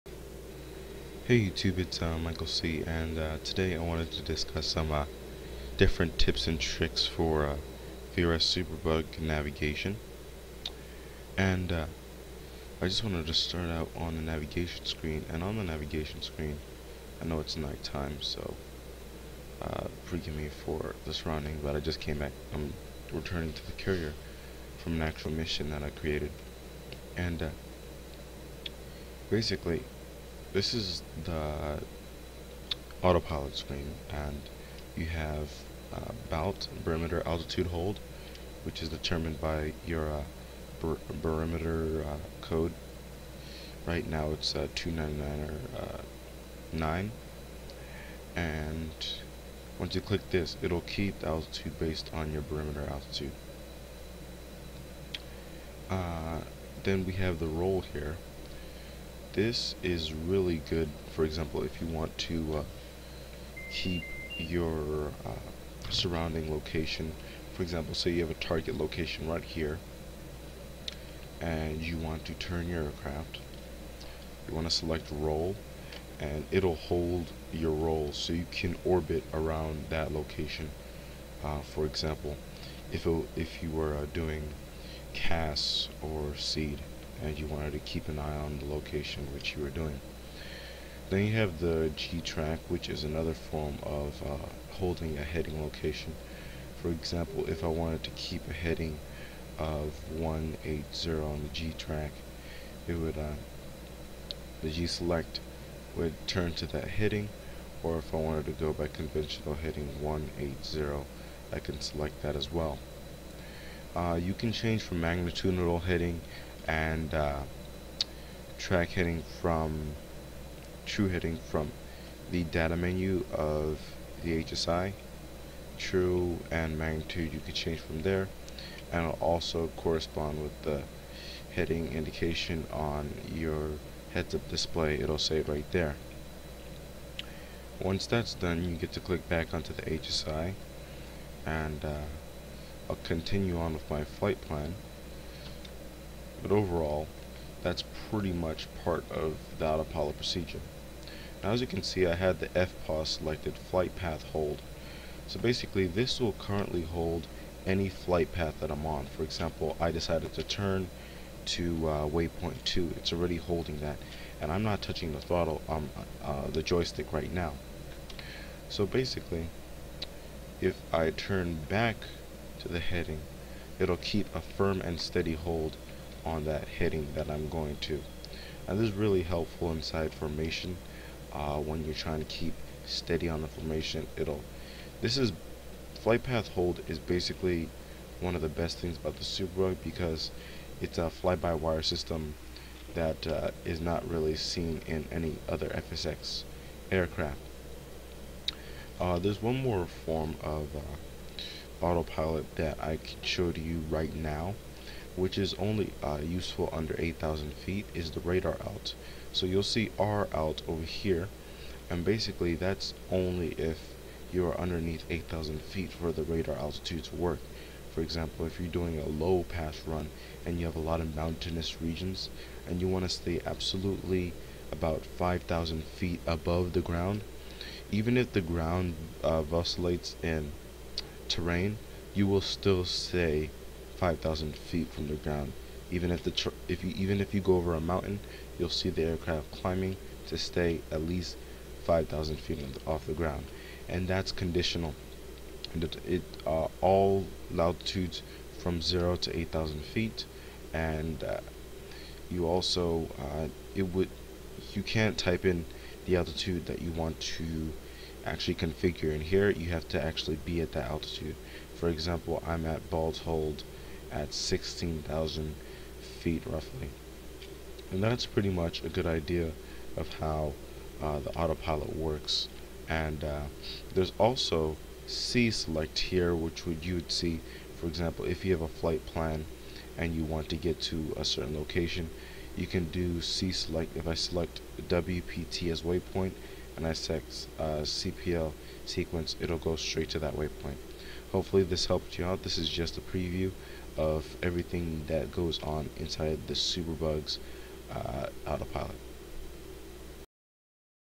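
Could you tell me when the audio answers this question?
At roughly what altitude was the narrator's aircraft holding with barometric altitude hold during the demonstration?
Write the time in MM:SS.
04:24.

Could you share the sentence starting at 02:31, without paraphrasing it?
Now as you can see I had the FPOS selected flight path hold.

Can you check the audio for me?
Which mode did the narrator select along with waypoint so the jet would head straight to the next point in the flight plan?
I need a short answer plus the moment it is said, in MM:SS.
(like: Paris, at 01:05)
CPL sequence, at 04:47.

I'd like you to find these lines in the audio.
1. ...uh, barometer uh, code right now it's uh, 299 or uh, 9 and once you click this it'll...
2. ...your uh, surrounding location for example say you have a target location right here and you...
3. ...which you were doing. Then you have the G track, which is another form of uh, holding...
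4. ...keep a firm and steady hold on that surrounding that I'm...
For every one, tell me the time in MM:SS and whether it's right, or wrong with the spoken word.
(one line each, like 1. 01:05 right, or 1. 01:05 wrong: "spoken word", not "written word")
1. 00:40 right
2. 01:04 right
3. 01:29 right
4. 02:53 wrong: "heading", not "surrounding".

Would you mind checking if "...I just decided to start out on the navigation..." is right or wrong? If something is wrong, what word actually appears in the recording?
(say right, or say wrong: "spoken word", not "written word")
wrong: "wanted", not "decided".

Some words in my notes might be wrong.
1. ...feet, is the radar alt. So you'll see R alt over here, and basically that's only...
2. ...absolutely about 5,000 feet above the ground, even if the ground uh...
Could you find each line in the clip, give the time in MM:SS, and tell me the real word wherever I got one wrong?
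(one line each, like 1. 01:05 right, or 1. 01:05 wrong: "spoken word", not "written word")
1. 03:27 right
2. 03:43 right.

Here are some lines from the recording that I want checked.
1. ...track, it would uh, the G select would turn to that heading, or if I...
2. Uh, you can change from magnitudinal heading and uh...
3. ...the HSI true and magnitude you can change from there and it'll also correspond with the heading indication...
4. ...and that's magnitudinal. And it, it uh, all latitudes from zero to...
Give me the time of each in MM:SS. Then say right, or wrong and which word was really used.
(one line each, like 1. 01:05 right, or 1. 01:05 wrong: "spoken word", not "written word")
1. 01:41 right
2. 01:53 right
3. 02:04 right
4. 04:03 wrong: "conditional", not "magnitudinal".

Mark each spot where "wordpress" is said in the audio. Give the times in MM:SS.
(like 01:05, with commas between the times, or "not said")
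not said.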